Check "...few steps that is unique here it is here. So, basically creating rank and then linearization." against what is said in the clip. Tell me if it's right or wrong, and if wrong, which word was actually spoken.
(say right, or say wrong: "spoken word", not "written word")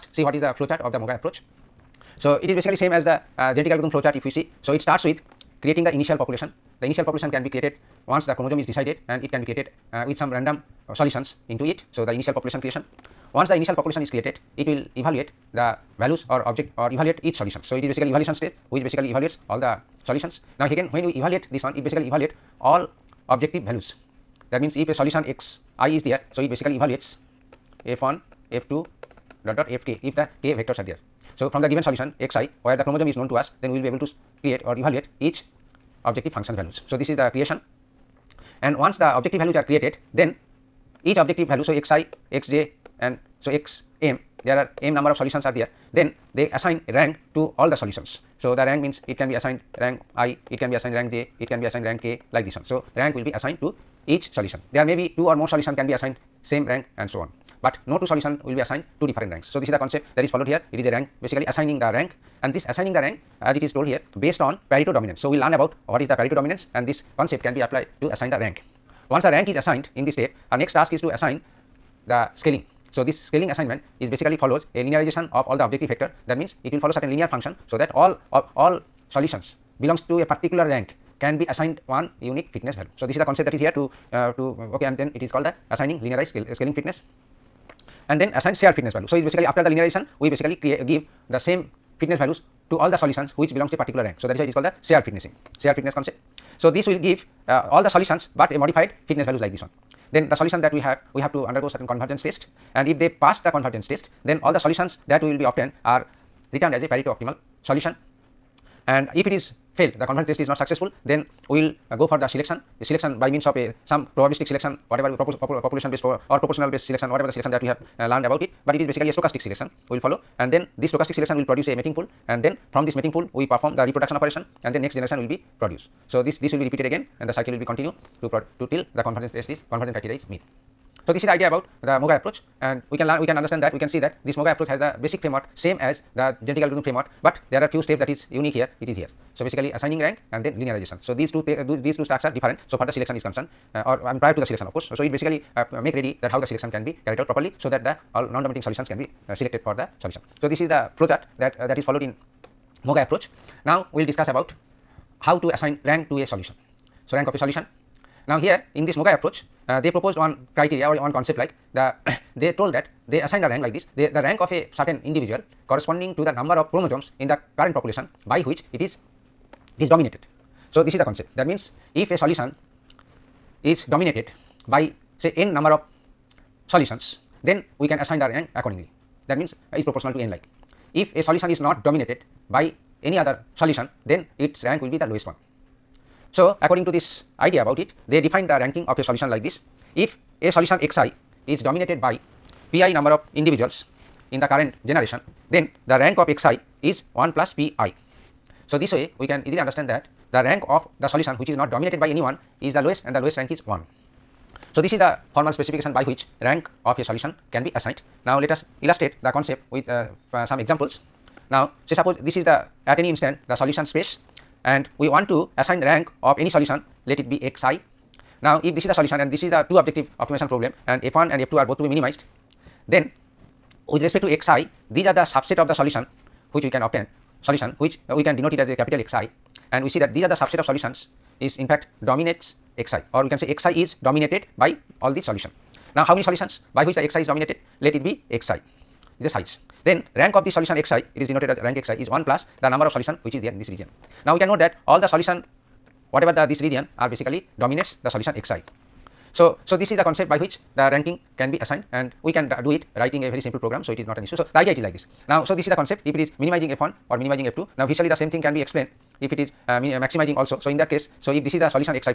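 wrong: "assigning", not "creating".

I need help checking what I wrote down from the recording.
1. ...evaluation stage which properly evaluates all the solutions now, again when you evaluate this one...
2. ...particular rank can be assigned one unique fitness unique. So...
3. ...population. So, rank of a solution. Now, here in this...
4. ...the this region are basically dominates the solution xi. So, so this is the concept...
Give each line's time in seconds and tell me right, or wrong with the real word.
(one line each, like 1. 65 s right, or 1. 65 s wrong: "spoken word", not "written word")
1. 18 s wrong: "basically", not "properly"
2. 80 s wrong: "value", not "unique"
3. 156 s wrong: "solution", not "population"
4. 246 s right.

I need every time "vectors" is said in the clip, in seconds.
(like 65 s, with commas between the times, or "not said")
30 s, 75 s.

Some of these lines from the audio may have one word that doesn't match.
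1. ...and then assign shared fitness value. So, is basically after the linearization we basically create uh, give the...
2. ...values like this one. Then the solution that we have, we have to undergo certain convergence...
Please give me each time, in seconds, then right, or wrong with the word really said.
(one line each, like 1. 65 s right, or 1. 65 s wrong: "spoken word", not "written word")
1. 88 s right
2. 99 s right.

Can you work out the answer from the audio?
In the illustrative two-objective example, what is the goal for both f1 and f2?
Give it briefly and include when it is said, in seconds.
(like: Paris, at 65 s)
Minimized, at 221 s.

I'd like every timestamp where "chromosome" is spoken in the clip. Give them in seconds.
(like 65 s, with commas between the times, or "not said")
8 s, 32 s, 166 s.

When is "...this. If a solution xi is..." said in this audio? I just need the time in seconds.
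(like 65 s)
189 s.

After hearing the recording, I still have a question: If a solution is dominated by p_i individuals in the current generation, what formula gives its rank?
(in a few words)
1 plus p_i.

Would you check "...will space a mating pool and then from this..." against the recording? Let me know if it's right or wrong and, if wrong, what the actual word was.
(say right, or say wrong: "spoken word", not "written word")
wrong: "produce", not "space".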